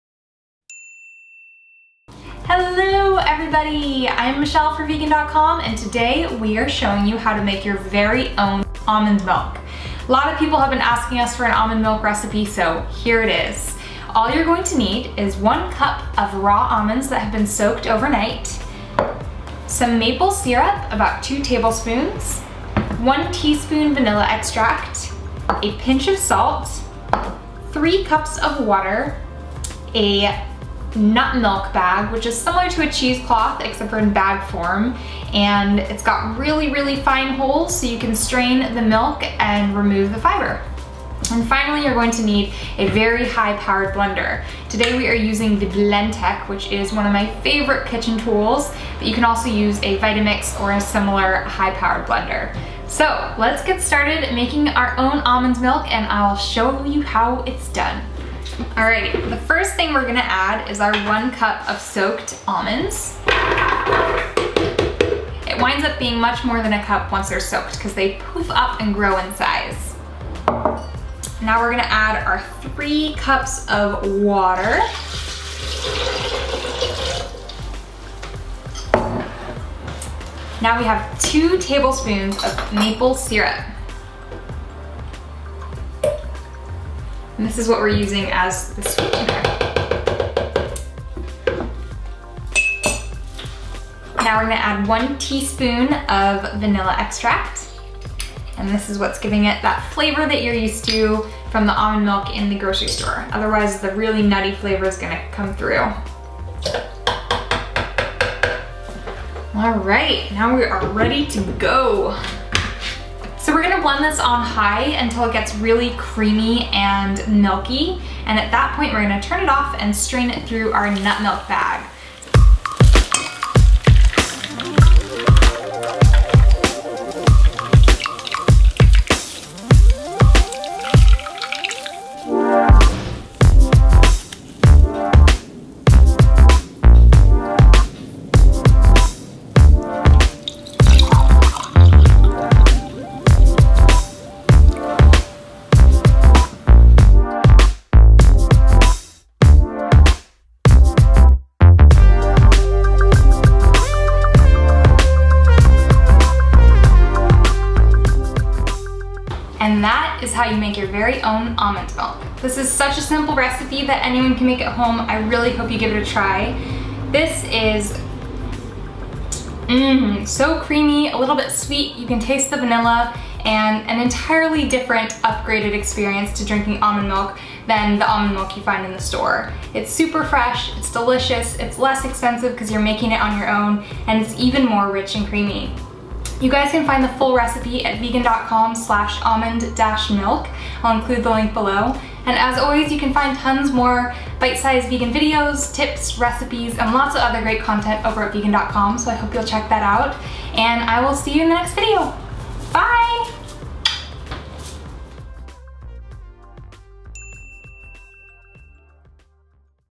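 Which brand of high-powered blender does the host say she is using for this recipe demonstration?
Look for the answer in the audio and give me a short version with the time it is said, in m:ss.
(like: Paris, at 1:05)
Blendtec, at 0:45.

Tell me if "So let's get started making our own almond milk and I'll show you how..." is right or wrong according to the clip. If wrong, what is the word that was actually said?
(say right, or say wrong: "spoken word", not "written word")
right.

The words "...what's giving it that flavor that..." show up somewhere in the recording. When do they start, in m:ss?
1:38.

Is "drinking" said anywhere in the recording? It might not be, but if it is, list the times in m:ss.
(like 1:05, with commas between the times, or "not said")
2:56.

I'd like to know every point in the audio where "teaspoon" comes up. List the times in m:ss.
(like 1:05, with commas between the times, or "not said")
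0:23, 1:35.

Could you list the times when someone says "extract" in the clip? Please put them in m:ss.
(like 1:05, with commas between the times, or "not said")
0:24, 1:36.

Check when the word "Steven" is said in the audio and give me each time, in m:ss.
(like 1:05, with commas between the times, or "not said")
not said.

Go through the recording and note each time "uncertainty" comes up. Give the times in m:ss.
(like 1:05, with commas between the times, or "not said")
not said.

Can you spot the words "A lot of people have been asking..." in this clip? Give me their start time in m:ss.
0:10.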